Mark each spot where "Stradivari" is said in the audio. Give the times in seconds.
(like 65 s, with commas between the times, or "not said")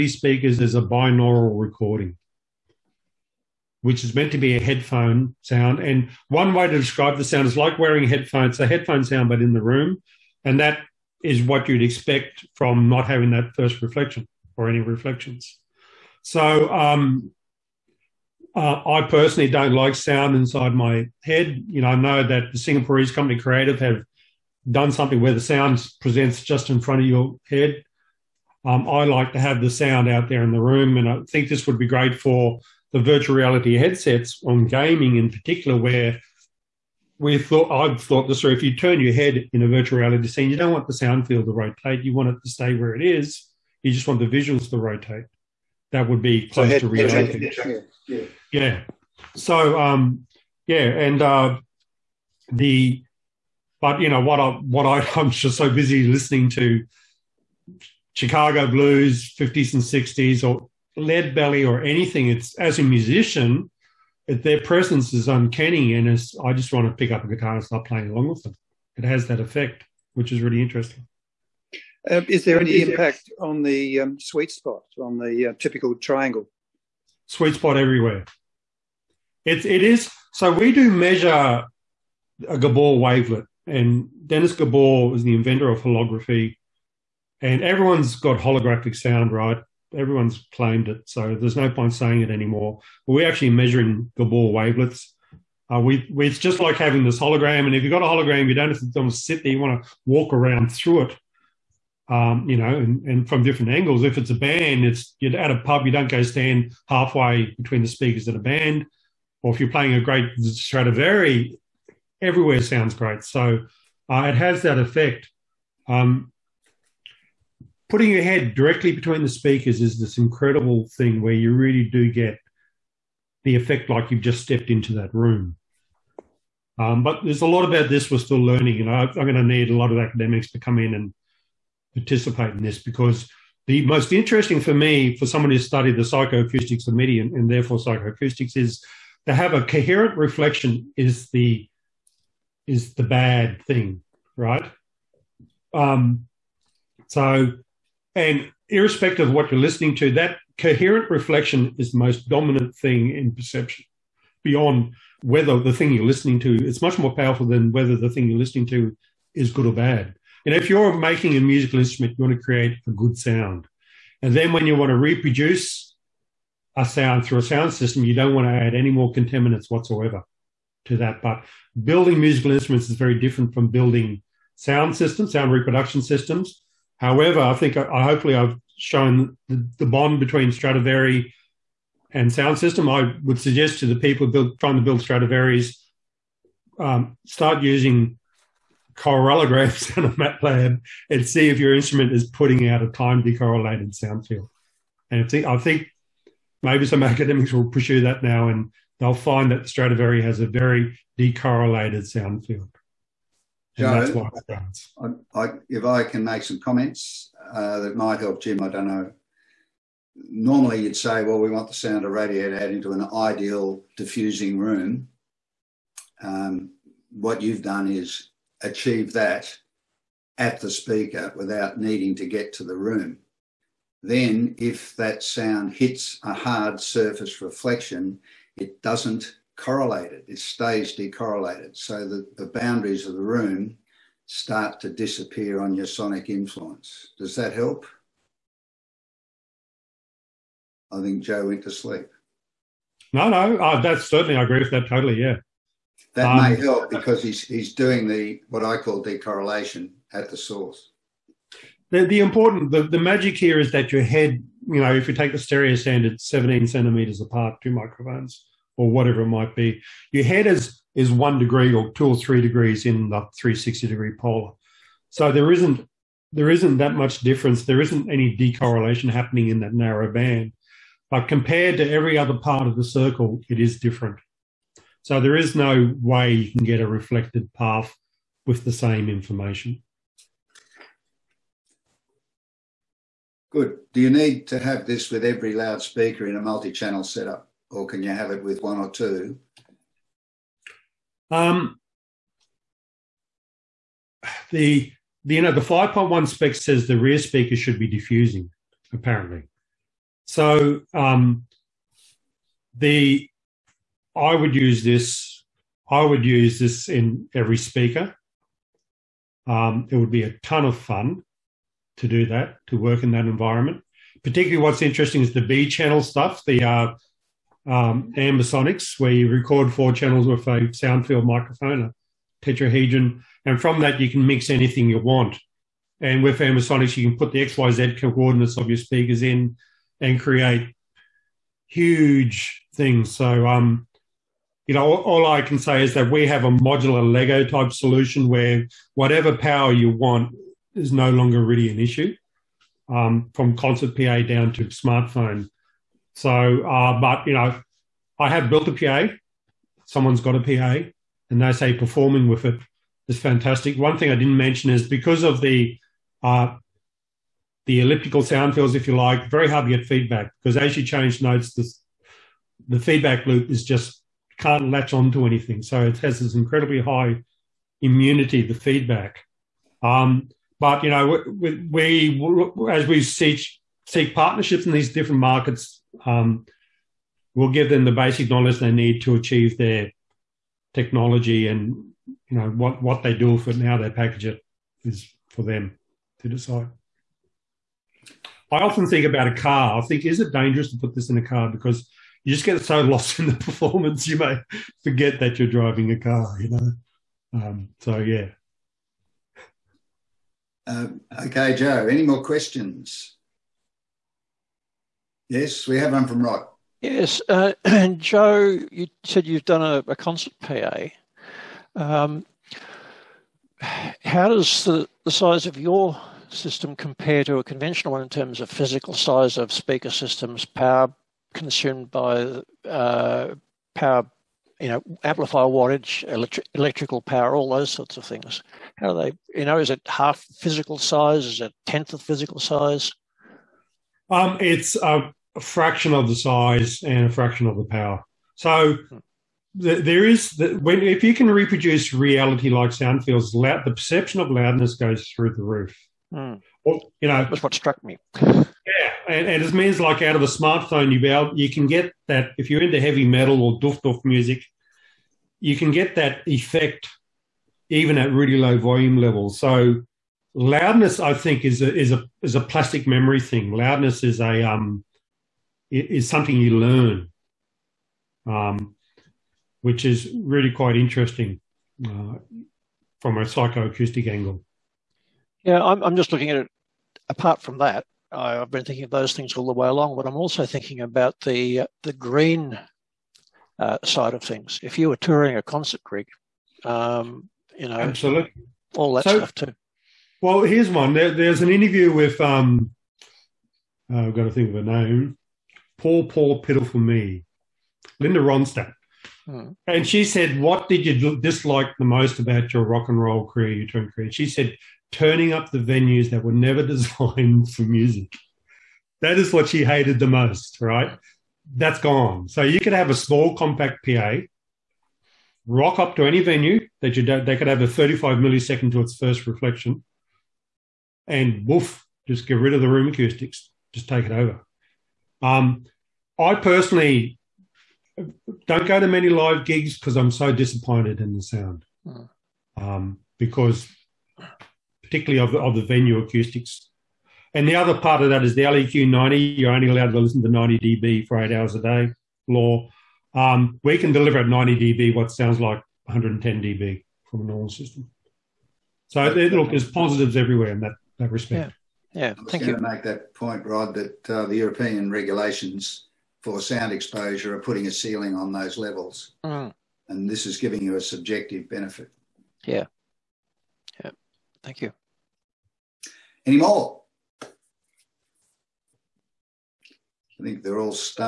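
110 s, 180 s, 185 s, 199 s.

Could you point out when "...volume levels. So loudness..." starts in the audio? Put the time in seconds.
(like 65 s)
458 s.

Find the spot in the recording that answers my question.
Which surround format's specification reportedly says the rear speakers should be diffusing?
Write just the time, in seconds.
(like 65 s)
295 s.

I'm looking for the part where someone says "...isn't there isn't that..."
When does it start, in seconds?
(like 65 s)
265 s.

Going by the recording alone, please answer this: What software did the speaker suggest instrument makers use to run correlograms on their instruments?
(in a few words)
MATLAB.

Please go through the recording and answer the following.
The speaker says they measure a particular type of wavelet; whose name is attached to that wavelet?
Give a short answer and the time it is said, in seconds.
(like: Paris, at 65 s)
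Dennis Gabor, at 84 s.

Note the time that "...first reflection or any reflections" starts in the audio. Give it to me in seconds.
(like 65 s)
13 s.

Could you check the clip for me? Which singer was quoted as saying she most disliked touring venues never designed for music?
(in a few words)
Linda Ronstadt.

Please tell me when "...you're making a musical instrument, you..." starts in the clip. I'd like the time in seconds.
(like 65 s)
160 s.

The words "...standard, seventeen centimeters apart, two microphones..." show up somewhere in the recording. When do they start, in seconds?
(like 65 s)
255 s.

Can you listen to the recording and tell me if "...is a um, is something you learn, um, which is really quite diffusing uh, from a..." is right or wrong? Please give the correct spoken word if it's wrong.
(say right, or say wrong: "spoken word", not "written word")
wrong: "interesting", not "diffusing".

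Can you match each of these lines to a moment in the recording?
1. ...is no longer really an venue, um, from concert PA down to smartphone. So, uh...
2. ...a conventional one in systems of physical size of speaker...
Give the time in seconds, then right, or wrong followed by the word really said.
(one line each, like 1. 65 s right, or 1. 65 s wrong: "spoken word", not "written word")
1. 340 s wrong: "issue", not "venue"
2. 417 s wrong: "terms", not "systems".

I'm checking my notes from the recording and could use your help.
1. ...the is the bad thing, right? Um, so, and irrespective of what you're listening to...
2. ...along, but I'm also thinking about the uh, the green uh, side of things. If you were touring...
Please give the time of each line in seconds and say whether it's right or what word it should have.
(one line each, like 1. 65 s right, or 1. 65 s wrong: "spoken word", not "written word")
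1. 141 s right
2. 479 s right.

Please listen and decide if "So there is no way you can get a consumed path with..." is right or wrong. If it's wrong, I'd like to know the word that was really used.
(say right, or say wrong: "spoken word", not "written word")
wrong: "reflected", not "consumed".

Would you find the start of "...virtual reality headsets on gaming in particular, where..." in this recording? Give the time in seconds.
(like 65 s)
32 s.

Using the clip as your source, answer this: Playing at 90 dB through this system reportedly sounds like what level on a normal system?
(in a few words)
110 dB.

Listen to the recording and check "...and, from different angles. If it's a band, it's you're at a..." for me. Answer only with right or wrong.
right.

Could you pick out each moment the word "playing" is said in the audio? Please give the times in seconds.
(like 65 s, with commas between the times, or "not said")
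67 s, 109 s.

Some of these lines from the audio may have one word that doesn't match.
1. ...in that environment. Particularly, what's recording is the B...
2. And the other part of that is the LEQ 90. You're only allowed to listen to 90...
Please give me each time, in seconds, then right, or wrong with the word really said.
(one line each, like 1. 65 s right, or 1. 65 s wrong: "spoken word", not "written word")
1. 313 s wrong: "interesting", not "recording"
2. 537 s right.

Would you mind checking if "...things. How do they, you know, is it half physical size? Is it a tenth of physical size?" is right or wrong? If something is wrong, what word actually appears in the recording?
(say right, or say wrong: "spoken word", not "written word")
right.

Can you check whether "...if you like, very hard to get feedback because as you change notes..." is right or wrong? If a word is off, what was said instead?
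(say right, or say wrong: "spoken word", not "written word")
right.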